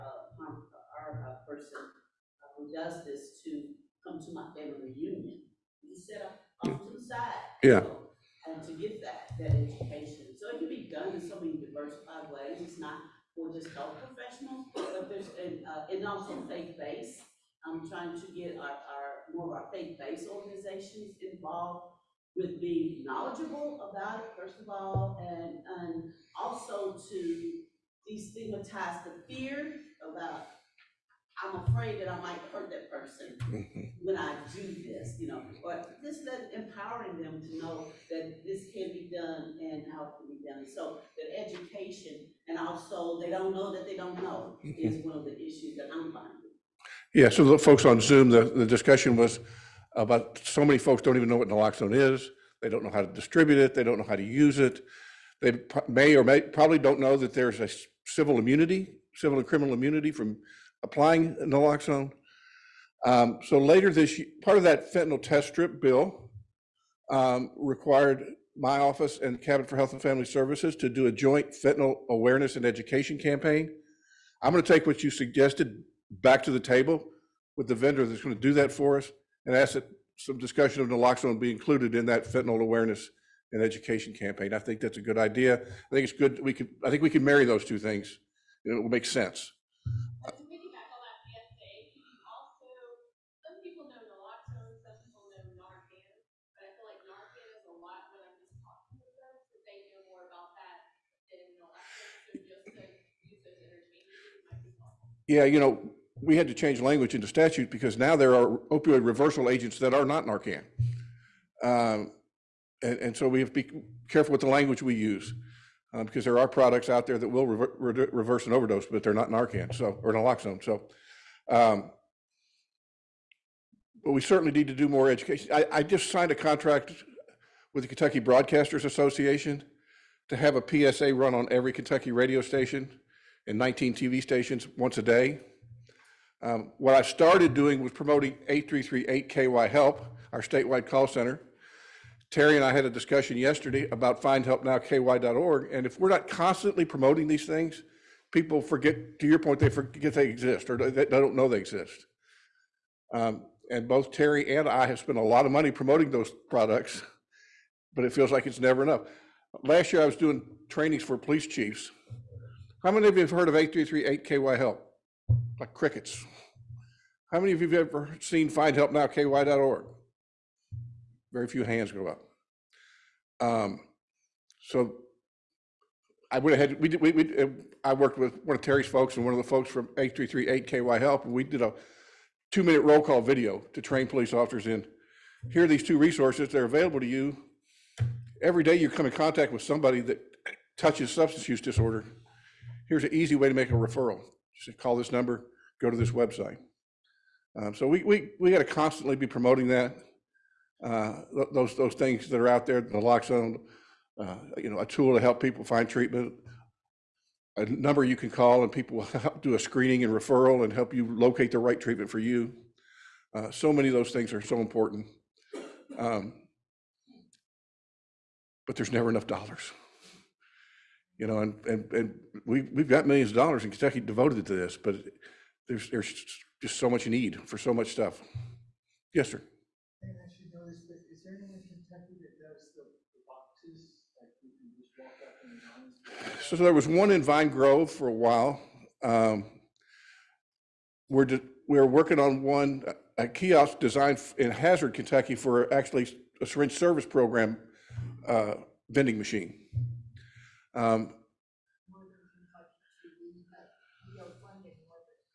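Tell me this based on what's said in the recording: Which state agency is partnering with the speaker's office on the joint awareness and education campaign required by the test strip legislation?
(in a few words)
Cabinet for Health and Family Services.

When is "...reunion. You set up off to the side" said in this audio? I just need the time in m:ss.
0:04.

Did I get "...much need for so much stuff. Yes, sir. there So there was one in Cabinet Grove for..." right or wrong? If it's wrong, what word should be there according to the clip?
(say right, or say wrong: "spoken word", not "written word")
wrong: "Vine", not "Cabinet".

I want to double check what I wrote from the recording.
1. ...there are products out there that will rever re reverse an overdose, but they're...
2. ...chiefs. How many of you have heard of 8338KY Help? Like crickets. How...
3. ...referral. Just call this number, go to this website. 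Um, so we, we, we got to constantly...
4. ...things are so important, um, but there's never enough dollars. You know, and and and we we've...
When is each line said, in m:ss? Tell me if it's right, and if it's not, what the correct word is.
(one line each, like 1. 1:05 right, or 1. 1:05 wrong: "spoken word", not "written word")
1. 1:56 right
2. 2:41 right
3. 3:13 right
4. 3:34 right.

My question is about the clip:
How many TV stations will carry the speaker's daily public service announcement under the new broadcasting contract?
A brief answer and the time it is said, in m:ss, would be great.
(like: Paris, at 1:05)
19, at 2:13.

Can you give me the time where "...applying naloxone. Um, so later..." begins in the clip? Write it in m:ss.
1:00.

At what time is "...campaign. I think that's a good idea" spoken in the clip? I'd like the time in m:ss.
1:24.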